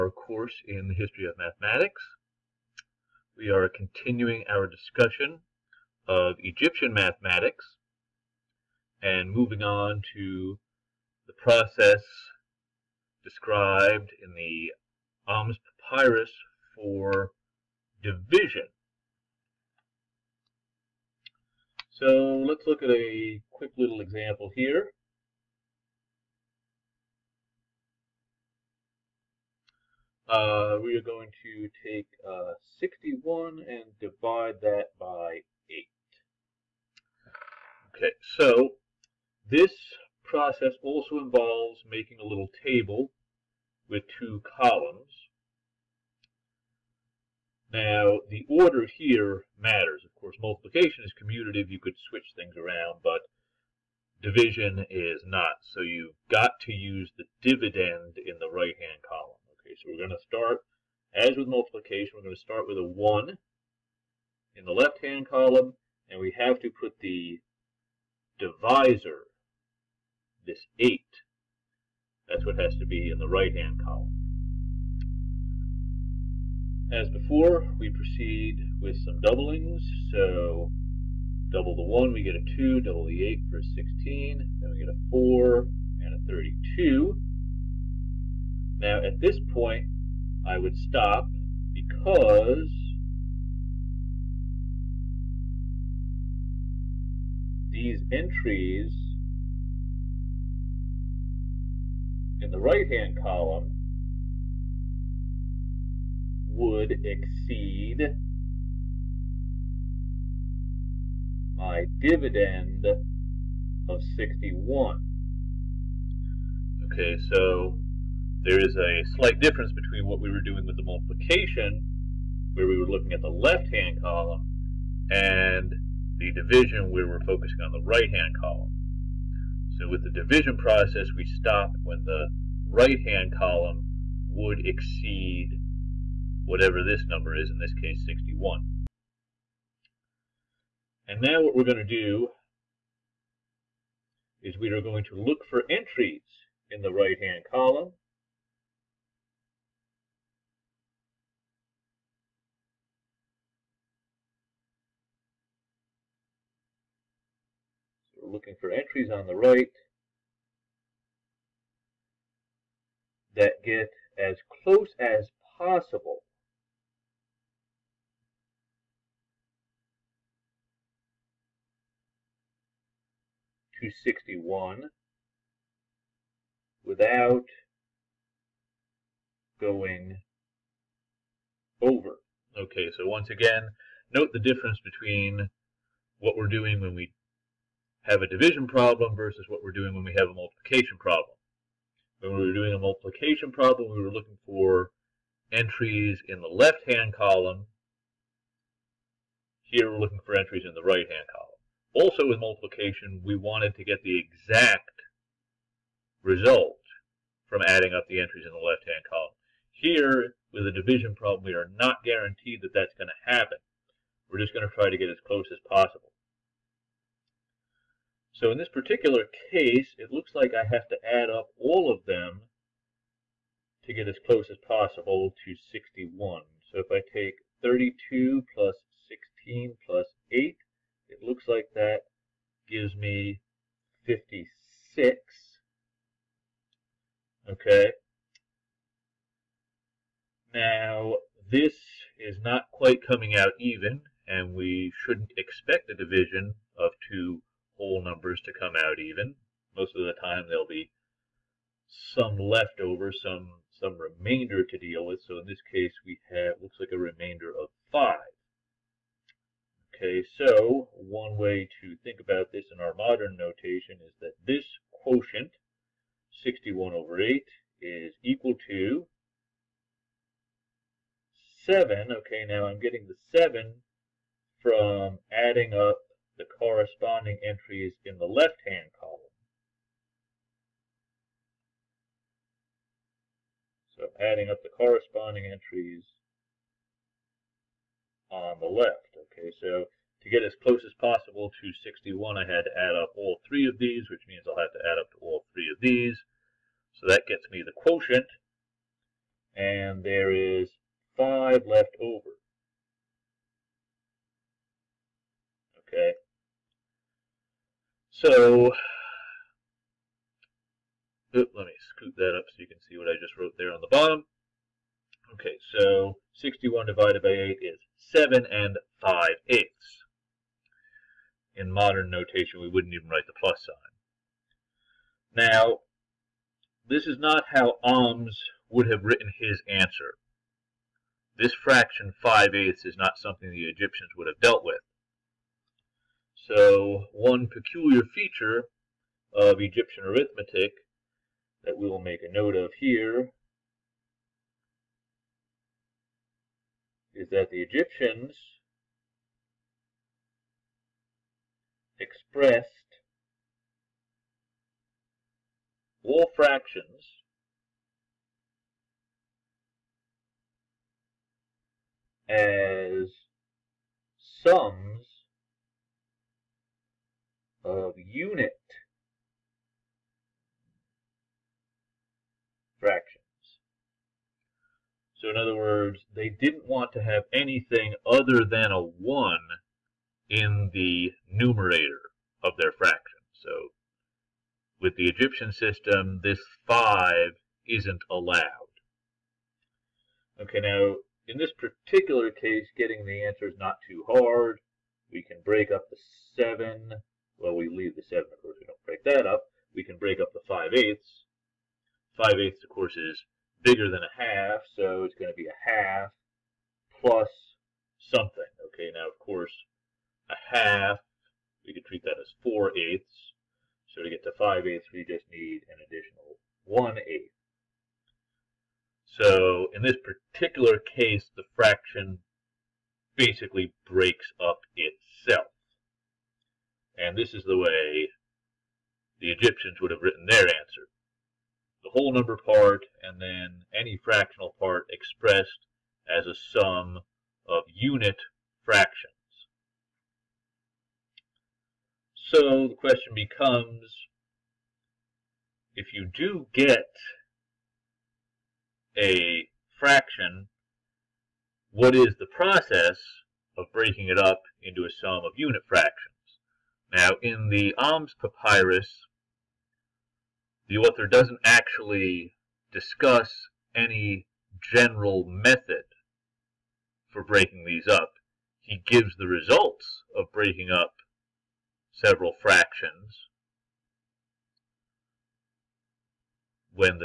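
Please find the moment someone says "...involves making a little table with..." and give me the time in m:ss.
0:41.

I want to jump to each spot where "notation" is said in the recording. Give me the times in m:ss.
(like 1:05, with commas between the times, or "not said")
4:23, 5:22.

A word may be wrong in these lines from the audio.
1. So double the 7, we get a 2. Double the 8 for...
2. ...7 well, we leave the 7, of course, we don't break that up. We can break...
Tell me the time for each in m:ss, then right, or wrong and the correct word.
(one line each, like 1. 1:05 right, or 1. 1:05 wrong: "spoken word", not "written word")
1. 1:20 wrong: "1", not "7"
2. 6:36 right.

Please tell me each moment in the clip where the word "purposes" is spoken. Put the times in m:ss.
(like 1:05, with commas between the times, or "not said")
not said.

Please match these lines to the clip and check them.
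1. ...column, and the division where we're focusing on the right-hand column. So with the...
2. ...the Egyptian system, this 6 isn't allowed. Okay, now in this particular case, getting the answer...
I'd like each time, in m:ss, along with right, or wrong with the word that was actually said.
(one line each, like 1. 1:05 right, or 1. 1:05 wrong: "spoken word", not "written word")
1. 2:04 right
2. 6:24 wrong: "5", not "6".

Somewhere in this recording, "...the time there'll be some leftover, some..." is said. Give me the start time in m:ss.
4:10.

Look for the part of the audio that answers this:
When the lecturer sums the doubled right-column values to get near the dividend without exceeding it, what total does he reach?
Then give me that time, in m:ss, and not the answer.
3:54.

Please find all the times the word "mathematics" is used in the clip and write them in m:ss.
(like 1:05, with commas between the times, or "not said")
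0:01, 0:06.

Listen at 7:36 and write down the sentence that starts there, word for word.
Now, in the Ahmes Papyrus, the author doesn't actually discuss any general method for breaking these up.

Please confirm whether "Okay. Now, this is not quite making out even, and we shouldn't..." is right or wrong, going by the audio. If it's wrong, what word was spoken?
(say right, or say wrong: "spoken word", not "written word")
wrong: "coming", not "making".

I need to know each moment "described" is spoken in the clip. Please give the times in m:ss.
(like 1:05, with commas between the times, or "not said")
0:13.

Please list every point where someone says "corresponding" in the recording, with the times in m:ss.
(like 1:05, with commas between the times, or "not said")
4:36, 4:44.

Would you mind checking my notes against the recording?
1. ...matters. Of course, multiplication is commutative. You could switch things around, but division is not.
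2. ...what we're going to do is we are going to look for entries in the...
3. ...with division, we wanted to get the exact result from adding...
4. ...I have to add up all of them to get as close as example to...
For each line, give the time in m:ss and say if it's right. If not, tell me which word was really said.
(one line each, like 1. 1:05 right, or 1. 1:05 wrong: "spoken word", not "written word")
1. 0:49 right
2. 2:21 right
3. 3:22 wrong: "multiplication", not "division"
4. 3:40 wrong: "possible", not "example".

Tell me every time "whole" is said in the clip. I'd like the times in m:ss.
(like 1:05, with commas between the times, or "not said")
4:07, 7:11.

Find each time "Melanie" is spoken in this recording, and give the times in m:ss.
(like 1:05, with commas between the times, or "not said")
not said.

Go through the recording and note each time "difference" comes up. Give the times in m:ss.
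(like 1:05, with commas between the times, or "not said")
1:59, 3:04.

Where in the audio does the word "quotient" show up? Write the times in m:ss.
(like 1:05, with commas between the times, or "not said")
4:24, 4:57.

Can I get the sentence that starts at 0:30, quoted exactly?
uh, we are going to take uh, 61 and divide that by 8.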